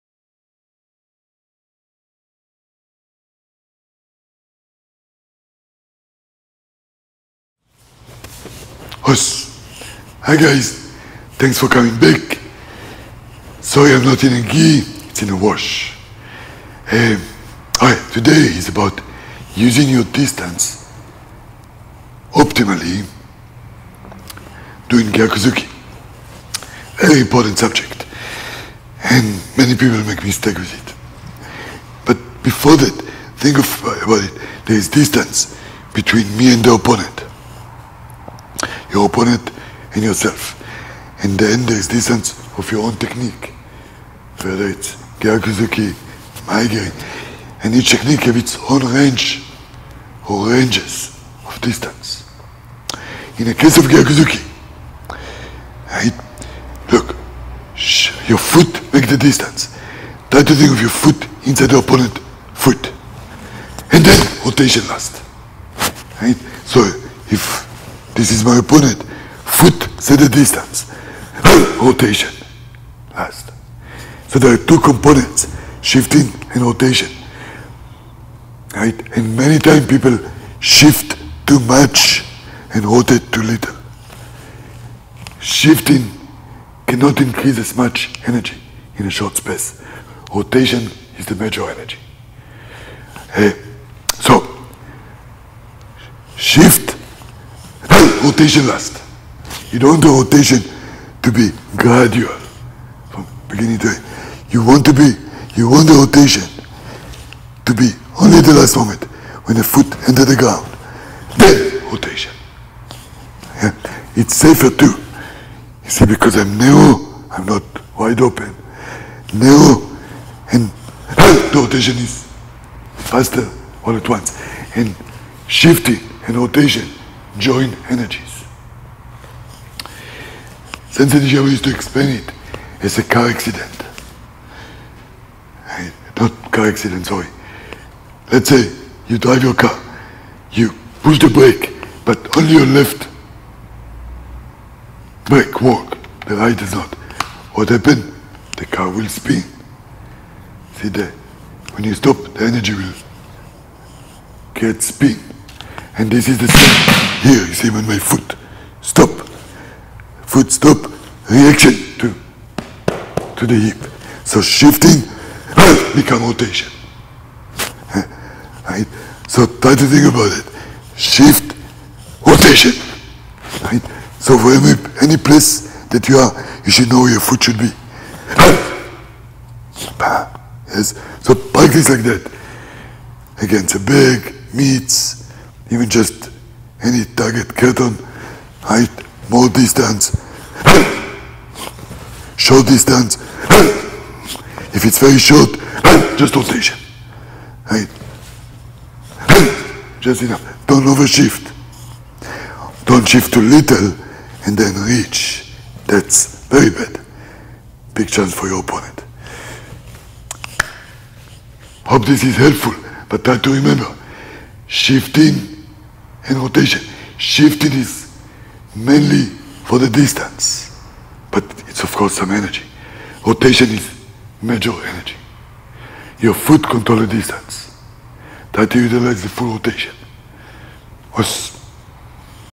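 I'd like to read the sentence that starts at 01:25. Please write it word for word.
Shifting cannot increase as much energy in a short space.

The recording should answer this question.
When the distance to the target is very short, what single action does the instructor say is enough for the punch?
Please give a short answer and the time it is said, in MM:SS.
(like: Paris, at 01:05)
Just rotation, at 03:16.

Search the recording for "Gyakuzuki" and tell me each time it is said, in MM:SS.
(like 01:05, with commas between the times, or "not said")
00:25, 00:45, 00:53.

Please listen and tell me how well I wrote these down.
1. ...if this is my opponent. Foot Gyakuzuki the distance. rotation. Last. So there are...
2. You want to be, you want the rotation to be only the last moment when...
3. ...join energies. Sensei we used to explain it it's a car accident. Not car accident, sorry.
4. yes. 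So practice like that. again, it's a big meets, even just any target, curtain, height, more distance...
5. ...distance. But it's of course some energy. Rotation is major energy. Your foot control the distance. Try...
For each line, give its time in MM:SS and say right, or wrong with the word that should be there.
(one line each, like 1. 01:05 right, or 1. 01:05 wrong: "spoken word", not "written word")
1. 01:07 wrong: "Set", not "Gyakuzuki"
2. 01:44 right
3. 02:07 right
4. 03:00 right
5. 03:39 right.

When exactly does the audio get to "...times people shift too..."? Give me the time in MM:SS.
01:19.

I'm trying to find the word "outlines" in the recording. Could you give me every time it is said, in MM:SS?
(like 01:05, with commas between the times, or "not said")
not said.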